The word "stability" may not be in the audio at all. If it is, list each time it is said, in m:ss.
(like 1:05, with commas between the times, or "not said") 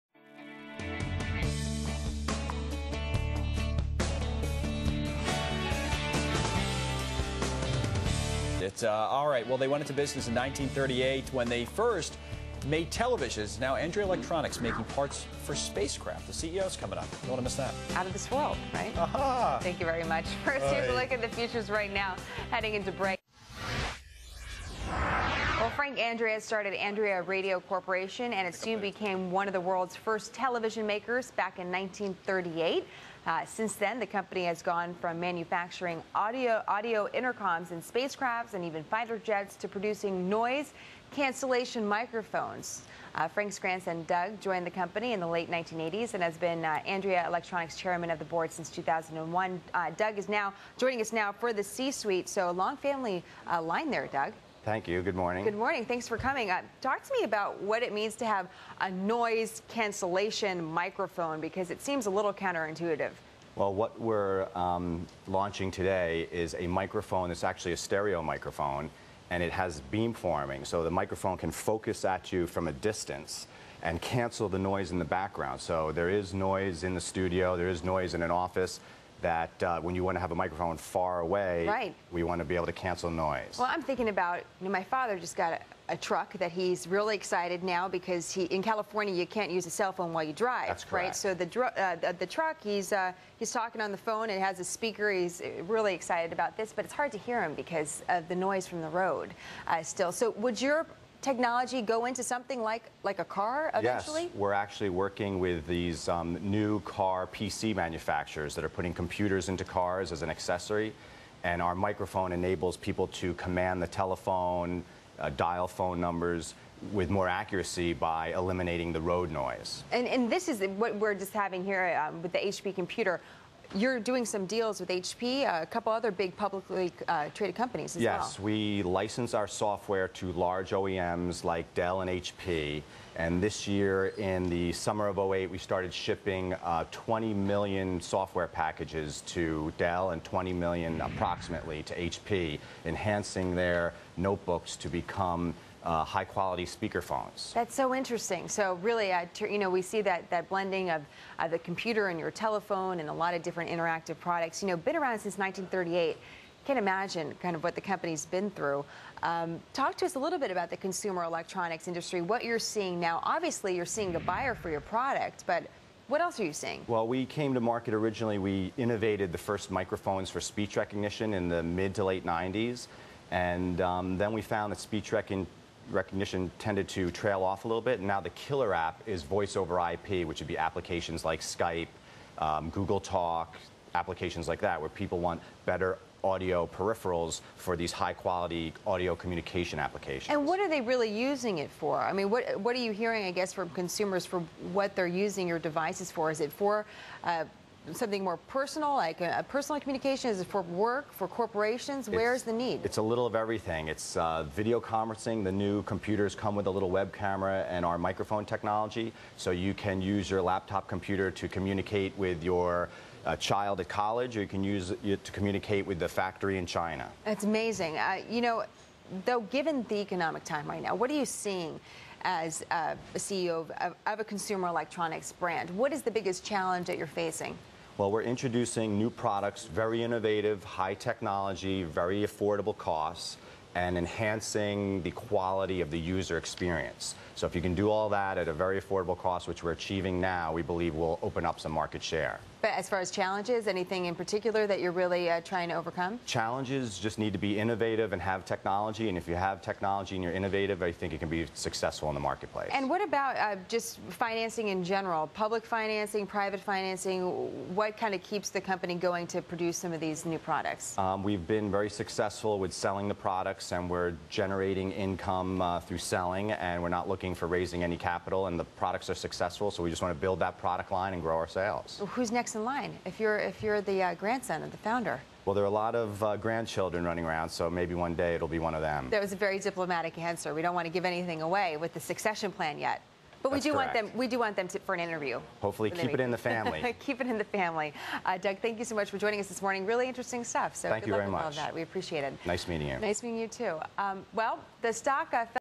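not said.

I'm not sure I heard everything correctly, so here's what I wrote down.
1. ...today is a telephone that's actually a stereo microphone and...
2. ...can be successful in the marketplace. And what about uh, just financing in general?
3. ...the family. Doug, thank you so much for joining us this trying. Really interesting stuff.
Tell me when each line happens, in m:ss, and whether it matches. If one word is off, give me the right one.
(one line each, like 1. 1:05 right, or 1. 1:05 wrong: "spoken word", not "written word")
1. 1:05 wrong: "microphone", not "telephone"
2. 4:11 right
3. 4:47 wrong: "morning", not "trying".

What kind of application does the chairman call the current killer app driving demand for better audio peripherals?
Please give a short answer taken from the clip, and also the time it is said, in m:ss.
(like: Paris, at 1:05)
voice over IP, at 2:59.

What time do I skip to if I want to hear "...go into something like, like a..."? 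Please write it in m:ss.
1:41.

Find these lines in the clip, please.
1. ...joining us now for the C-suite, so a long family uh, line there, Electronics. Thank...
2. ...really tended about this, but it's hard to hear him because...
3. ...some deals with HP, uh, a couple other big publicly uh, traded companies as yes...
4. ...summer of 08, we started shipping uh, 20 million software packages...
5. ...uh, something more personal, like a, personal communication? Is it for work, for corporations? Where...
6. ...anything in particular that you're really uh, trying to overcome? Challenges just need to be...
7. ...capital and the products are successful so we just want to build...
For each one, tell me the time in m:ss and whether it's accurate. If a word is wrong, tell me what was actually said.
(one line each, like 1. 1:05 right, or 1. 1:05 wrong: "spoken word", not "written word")
1. 0:50 wrong: "Doug", not "Electronics"
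2. 1:35 wrong: "excited", not "tended"
3. 2:04 right
4. 2:14 right
5. 3:17 right
6. 4:03 right
7. 4:27 right.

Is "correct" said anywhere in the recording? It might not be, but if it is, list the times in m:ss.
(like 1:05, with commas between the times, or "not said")
1:30, 4:43.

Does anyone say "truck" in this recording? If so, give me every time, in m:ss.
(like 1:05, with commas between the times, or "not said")
1:25, 1:32.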